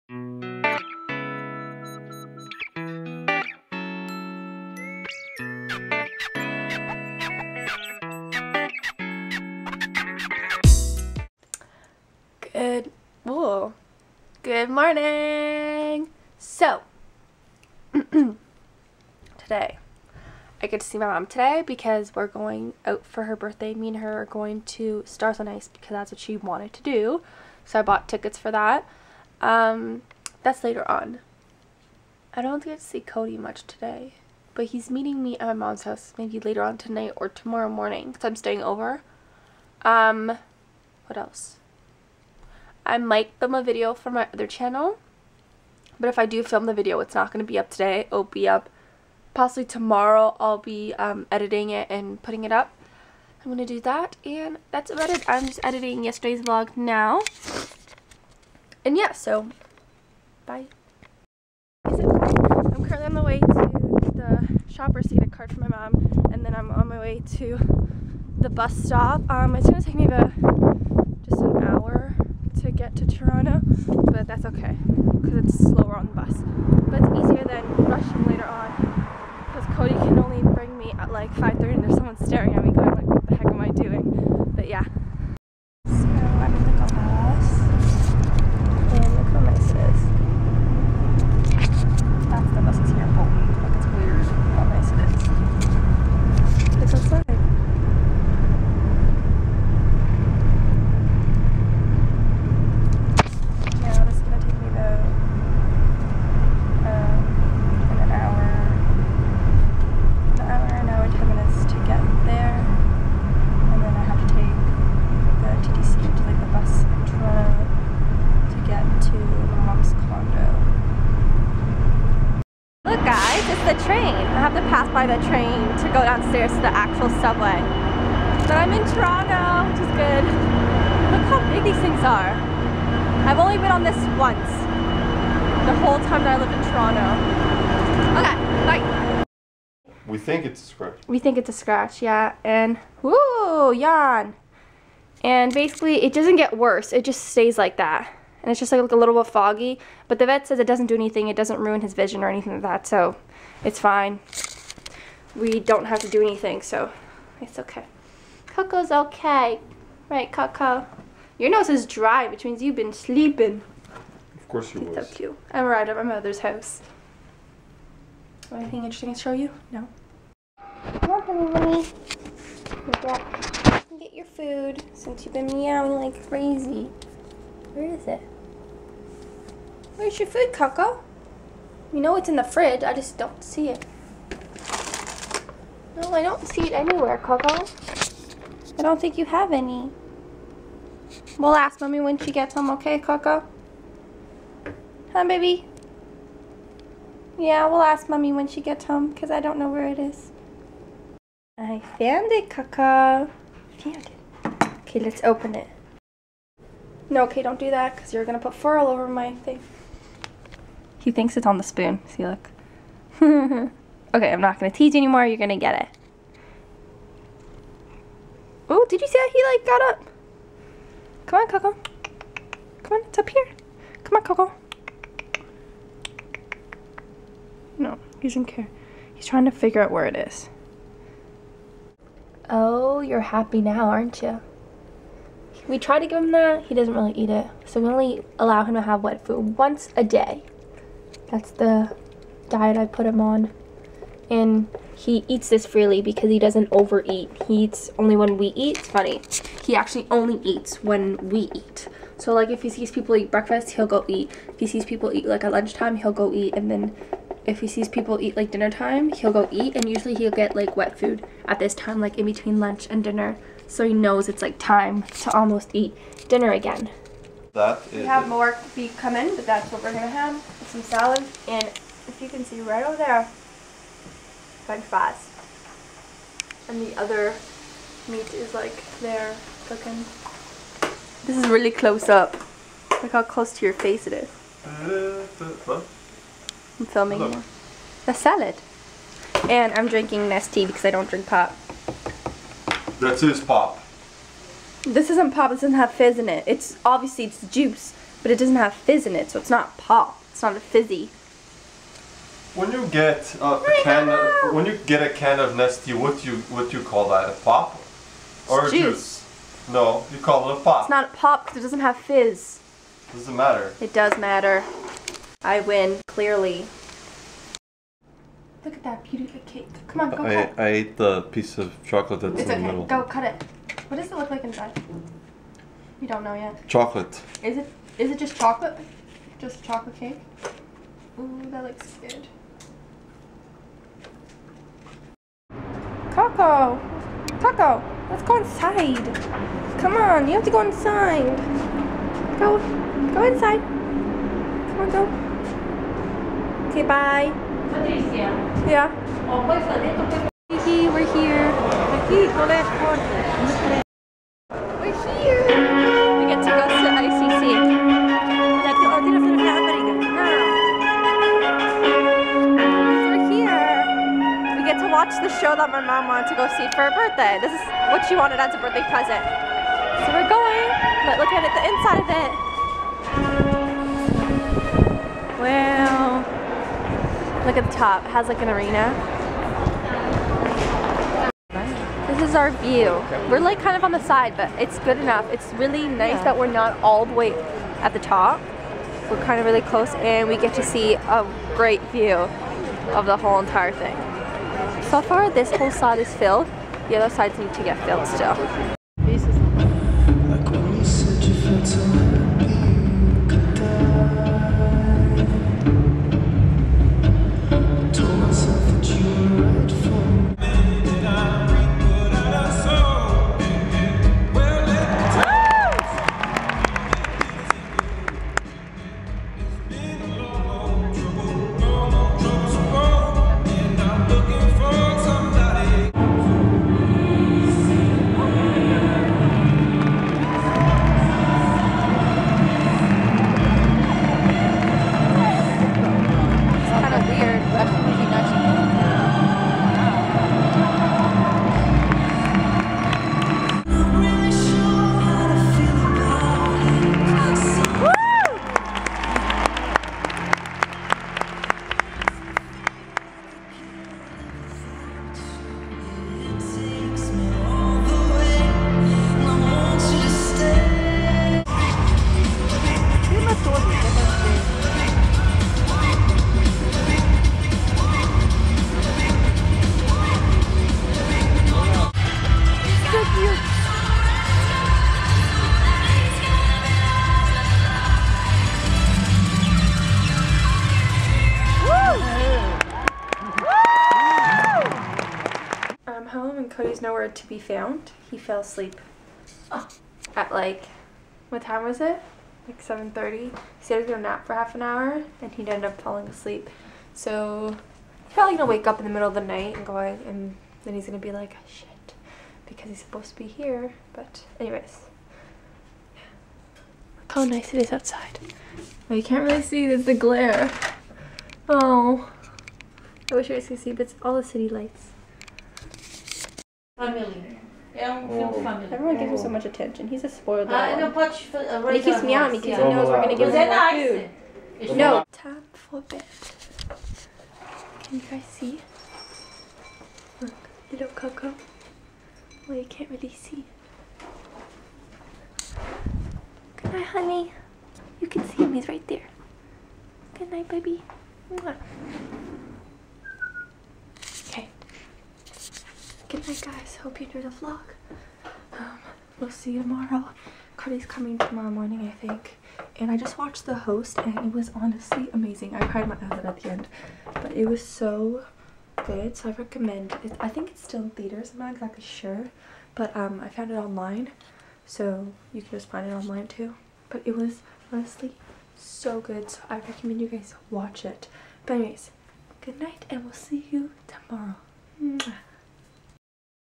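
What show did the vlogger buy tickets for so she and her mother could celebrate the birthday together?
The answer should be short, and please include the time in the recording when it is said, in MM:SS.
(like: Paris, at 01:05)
Stars on Ice, at 00:25.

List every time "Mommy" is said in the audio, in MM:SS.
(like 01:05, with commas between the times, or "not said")
03:11, 03:18.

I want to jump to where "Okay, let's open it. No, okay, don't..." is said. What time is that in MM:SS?
03:24.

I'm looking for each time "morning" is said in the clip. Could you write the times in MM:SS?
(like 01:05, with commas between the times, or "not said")
00:14, 00:37, 09:11.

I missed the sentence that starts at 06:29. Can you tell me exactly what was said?
We're kind of really close and we get to see a great view of the whole entire thing.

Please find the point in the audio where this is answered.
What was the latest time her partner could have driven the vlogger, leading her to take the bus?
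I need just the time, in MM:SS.
01:21.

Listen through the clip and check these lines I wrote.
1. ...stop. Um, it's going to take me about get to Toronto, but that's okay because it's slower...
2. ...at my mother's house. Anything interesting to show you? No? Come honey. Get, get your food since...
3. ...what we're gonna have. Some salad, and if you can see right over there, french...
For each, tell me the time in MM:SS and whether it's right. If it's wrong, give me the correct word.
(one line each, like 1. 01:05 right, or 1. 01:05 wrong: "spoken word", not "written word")
1. 01:08 right
2. 02:45 right
3. 04:29 right.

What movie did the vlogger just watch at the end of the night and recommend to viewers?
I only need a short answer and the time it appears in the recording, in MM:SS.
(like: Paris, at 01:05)
The Host, at 09:13.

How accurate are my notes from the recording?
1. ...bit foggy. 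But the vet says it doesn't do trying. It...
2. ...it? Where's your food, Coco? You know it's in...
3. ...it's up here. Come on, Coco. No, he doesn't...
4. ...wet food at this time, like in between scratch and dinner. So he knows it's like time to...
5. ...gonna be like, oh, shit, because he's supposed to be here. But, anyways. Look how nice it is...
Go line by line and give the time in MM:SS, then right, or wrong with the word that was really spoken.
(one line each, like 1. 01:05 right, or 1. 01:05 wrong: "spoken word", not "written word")
1. 02:29 wrong: "anything", not "trying"
2. 02:58 right
3. 03:43 right
4. 04:20 wrong: "lunch", not "scratch"
5. 08:20 right.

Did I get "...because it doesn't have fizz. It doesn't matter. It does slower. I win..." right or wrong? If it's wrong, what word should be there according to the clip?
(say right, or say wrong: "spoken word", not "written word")
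wrong: "matter", not "slower".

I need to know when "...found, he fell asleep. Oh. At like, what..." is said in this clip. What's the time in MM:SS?
08:07.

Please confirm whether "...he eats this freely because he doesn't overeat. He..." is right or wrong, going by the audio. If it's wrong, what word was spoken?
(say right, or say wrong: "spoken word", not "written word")
right.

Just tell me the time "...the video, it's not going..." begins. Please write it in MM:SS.
00:46.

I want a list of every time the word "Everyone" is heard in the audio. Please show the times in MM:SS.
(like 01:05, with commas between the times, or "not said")
08:38.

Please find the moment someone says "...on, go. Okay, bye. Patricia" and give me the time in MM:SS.
05:44.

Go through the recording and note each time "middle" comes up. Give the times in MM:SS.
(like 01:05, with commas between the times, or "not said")
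05:22, 08:18.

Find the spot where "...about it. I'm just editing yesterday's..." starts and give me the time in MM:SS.
00:54.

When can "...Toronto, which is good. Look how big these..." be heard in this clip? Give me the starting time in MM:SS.
02:08.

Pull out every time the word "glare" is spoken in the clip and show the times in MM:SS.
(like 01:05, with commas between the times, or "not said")
08:29.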